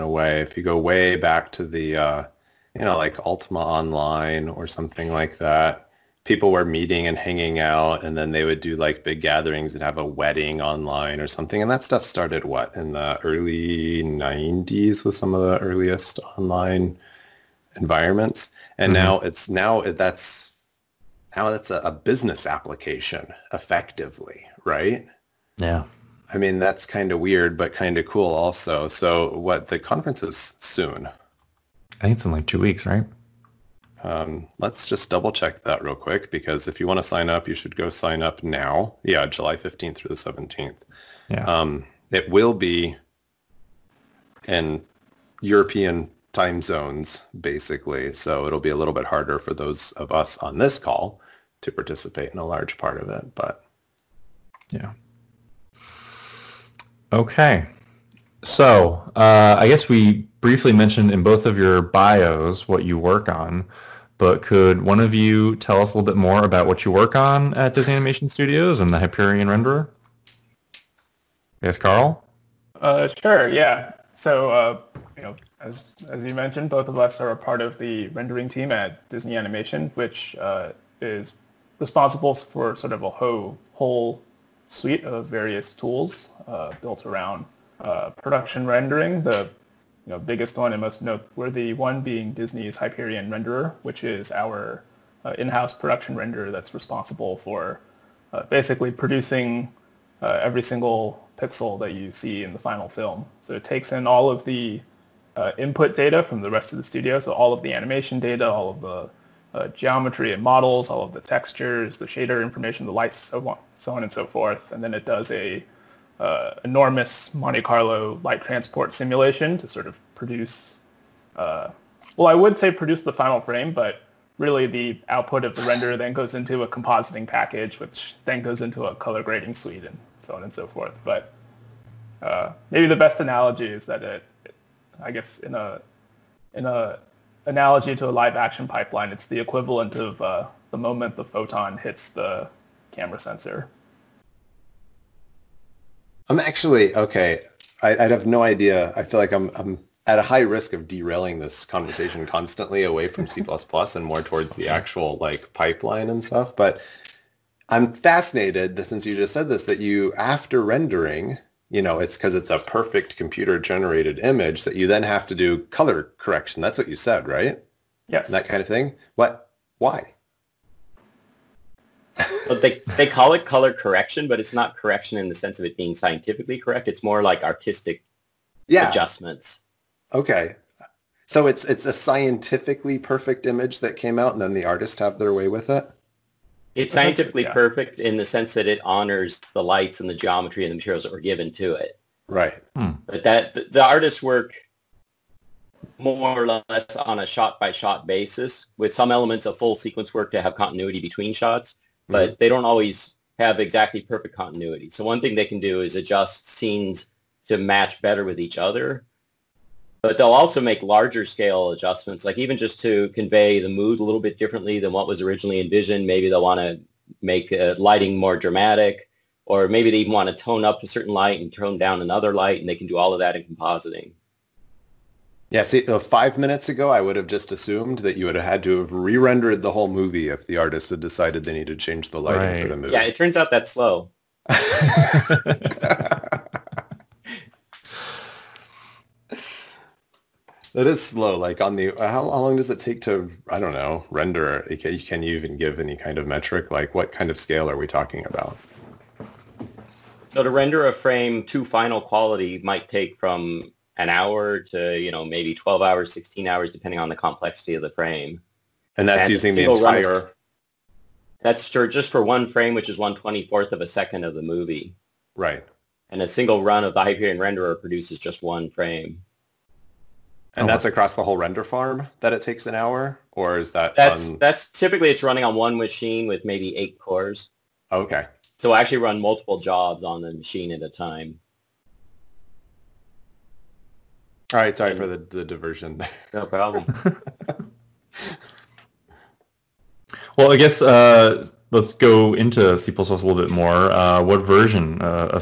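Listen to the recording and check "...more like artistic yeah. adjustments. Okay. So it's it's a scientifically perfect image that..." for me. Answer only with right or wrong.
right.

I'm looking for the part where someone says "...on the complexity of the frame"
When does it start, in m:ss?
4:16.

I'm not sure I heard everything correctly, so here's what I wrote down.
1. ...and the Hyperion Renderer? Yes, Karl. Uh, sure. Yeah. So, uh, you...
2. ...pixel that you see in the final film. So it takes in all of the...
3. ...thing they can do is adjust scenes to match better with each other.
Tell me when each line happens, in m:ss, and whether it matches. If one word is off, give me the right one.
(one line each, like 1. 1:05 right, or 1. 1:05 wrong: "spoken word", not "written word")
1. 1:08 right
2. 1:41 right
3. 3:25 right.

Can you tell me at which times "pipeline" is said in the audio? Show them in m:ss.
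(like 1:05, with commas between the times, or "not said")
2:18, 2:35.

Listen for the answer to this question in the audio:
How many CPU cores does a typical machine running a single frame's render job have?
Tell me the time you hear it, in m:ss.
4:36.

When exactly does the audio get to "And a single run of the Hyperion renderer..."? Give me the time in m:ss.
4:26.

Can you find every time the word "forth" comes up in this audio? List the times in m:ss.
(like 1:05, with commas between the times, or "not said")
1:54, 2:10.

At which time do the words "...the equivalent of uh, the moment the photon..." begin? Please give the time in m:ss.
2:19.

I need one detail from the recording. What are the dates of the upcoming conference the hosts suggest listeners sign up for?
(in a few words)
July 15th through 17th.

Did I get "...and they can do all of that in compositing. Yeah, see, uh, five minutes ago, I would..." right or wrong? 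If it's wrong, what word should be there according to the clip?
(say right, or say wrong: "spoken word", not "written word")
right.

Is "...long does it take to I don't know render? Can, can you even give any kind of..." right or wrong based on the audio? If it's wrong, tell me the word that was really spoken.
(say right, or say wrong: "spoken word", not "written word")
right.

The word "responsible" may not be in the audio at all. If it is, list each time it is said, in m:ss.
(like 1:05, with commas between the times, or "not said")
1:21, 1:36.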